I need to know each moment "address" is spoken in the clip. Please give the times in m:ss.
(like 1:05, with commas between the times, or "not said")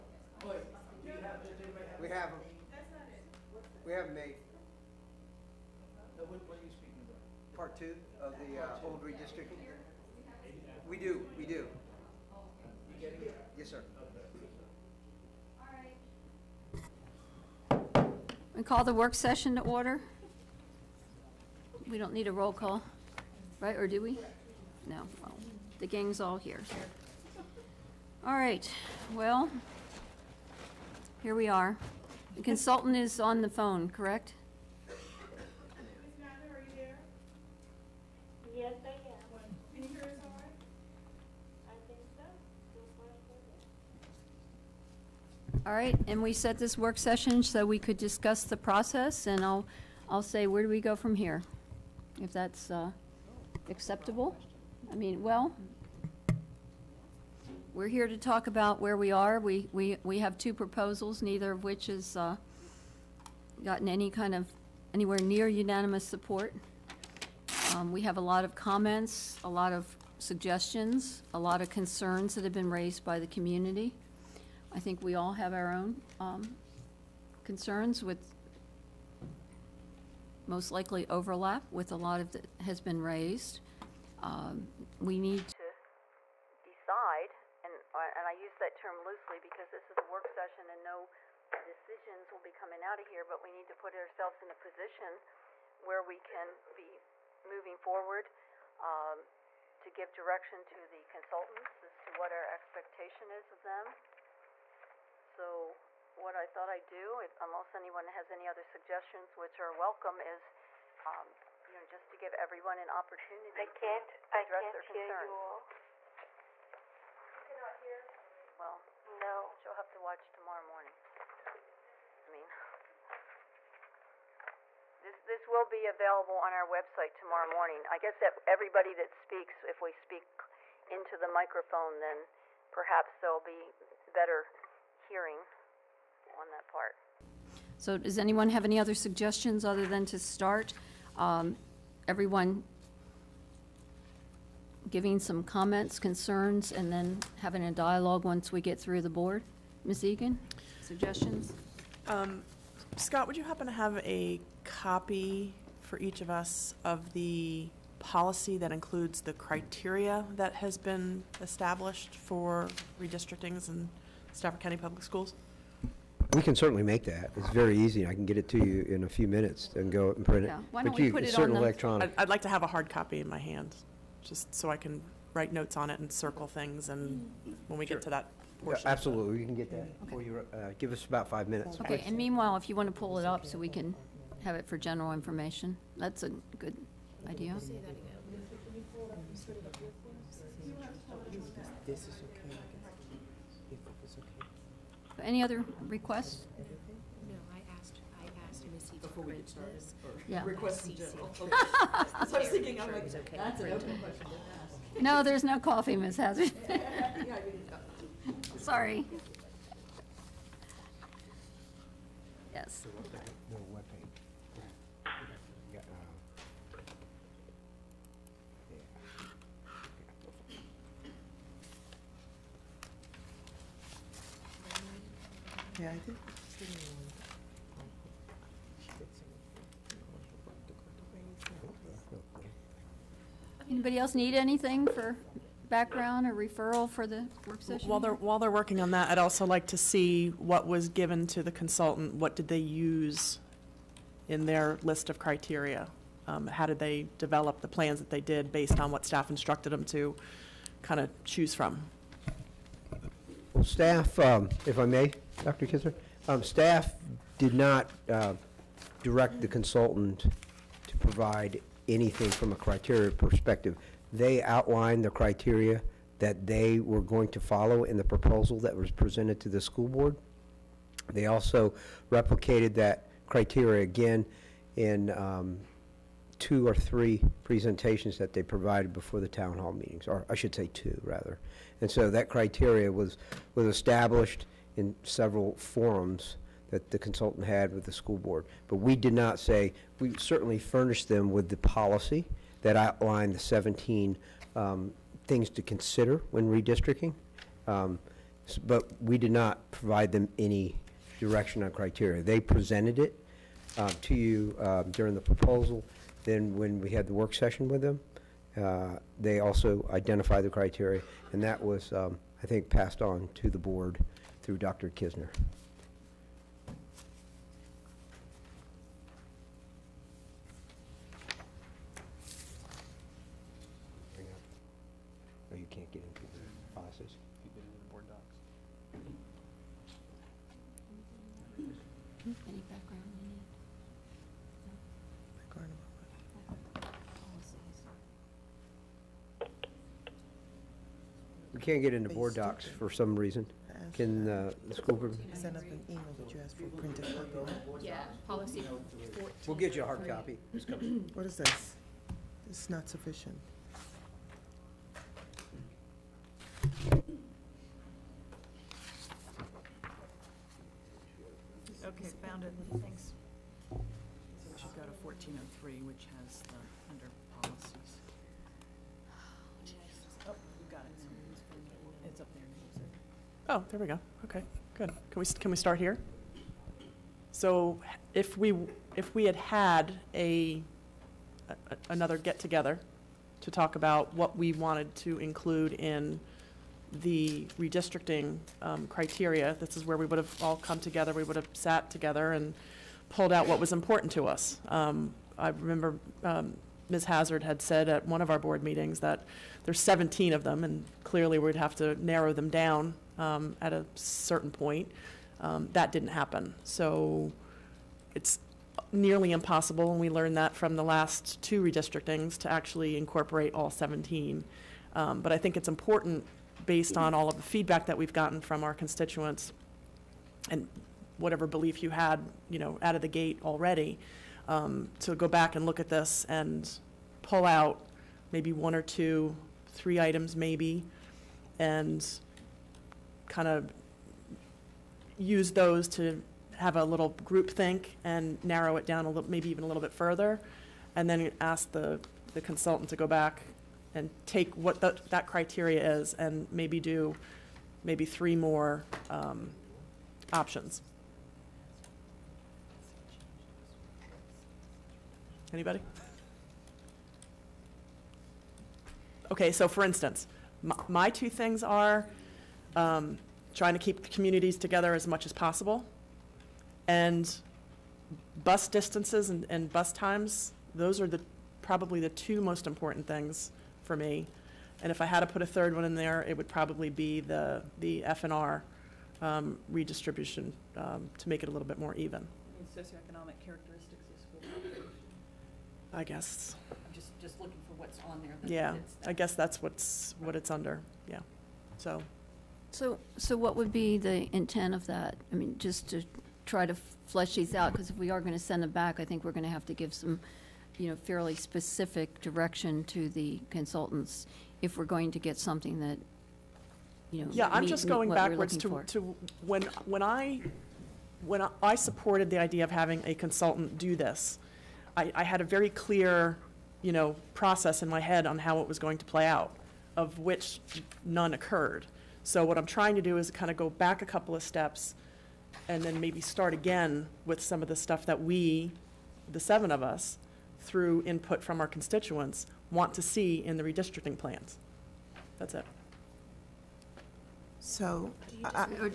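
1:54.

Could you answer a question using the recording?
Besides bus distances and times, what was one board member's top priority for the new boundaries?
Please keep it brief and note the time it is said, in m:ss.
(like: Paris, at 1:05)
keep communities together, at 7:43.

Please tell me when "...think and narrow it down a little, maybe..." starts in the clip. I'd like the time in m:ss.
7:17.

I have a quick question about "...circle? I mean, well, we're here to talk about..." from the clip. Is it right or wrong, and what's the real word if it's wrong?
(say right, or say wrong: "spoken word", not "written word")
wrong: "acceptable", not "circle".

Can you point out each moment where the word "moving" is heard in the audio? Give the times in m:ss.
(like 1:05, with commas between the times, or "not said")
1:37.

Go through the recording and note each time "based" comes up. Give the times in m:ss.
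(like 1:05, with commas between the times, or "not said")
4:08, 6:56.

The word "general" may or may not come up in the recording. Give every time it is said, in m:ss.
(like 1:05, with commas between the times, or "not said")
3:04, 3:20.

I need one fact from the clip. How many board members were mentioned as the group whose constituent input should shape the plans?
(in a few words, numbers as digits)
7.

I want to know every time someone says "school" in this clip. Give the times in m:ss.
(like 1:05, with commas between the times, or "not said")
2:45, 4:29, 4:47, 5:44, 8:04.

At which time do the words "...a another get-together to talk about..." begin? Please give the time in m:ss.
6:21.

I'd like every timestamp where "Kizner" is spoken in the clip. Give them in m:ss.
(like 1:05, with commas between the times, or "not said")
4:15, 5:14.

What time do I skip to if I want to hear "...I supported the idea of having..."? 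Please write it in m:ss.
8:31.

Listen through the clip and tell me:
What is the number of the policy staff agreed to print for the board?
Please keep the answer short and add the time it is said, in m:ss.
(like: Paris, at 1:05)
14, at 5:48.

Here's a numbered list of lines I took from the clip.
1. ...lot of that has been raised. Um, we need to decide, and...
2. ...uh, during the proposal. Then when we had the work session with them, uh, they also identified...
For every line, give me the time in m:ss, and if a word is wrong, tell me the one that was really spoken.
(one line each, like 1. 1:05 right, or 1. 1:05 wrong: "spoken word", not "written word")
1. 1:21 right
2. 5:04 right.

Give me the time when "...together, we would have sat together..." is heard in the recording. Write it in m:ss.
6:30.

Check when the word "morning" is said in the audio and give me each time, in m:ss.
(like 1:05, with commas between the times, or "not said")
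2:00, 2:07.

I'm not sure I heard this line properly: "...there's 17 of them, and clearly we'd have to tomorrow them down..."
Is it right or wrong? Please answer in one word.
wrong.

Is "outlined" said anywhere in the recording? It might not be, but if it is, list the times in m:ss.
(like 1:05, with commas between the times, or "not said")
4:24, 4:52.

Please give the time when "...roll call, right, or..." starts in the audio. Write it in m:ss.
0:22.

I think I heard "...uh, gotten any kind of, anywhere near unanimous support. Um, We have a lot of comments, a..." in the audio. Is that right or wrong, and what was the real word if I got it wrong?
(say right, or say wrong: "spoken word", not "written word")
right.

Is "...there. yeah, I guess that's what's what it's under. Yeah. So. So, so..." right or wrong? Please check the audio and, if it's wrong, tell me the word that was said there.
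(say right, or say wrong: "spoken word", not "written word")
right.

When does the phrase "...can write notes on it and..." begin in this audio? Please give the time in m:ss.
2:54.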